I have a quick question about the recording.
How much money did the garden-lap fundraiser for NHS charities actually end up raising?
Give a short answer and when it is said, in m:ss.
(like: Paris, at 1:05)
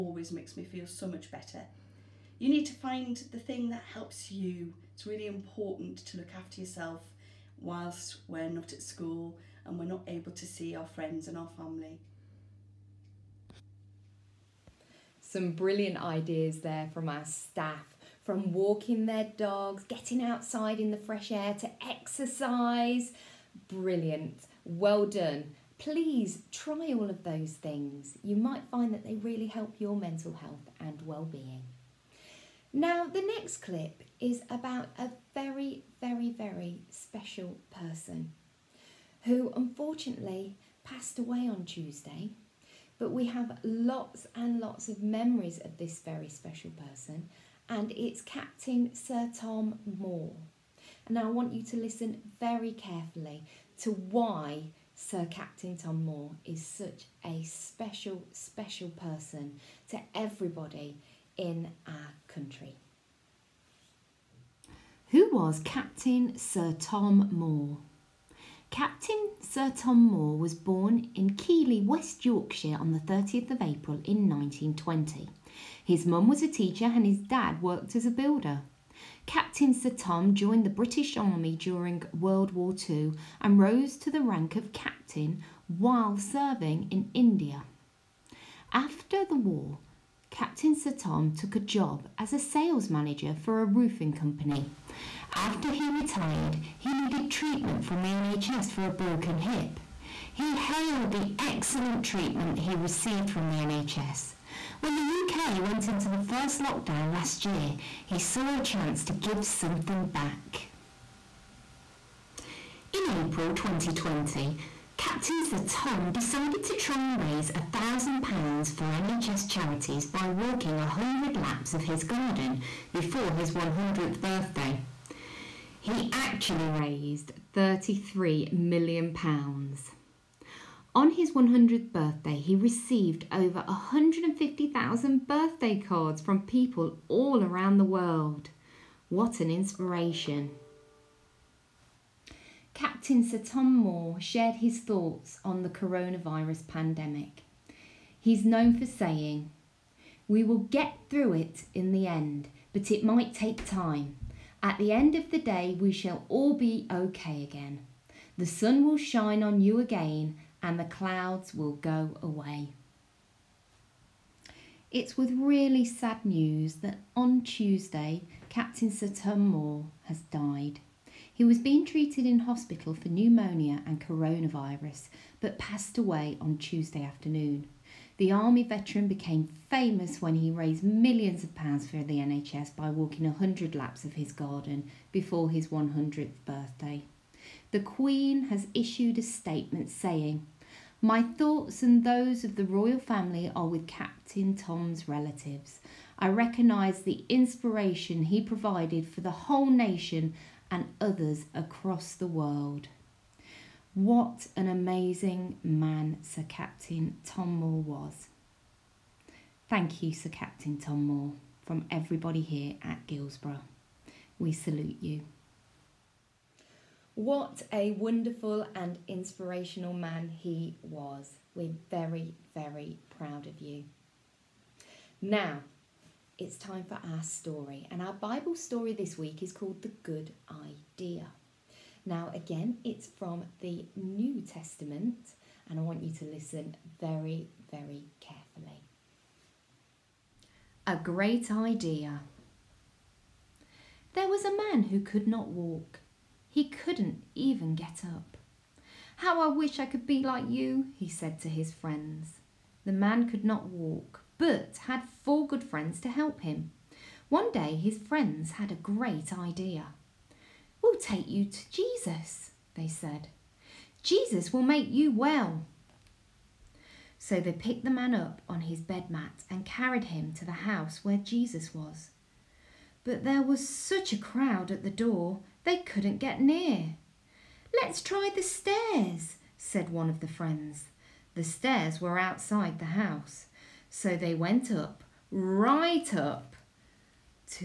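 £33 million, at 2:07.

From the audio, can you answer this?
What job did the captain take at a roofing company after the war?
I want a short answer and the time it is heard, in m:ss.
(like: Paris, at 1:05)
Sales manager, at 1:32.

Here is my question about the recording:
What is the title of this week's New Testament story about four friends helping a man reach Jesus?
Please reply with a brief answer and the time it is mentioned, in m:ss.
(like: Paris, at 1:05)
The Good Idea, at 3:49.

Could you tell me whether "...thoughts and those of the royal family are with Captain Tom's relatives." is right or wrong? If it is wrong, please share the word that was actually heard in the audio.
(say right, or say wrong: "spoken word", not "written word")
right.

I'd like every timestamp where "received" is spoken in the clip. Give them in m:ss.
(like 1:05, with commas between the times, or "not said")
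1:42, 2:12.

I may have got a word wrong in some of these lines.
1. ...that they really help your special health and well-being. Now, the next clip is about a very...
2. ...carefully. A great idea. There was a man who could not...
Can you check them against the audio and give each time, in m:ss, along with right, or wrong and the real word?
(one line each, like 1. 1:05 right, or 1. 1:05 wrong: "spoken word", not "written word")
1. 0:28 wrong: "mental", not "special"
2. 3:58 right.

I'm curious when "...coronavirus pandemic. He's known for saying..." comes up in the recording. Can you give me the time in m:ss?
2:25.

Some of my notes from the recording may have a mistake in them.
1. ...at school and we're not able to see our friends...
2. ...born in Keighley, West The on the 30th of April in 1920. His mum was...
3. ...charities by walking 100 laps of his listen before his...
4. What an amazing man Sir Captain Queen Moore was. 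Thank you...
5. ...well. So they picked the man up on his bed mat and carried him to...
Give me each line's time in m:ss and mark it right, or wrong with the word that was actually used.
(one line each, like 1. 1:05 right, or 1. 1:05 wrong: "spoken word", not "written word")
1. 0:08 right
2. 1:10 wrong: "Yorkshire", not "The"
3. 1:59 wrong: "garden", not "listen"
4. 3:23 wrong: "Tom", not "Queen"
5. 4:25 right.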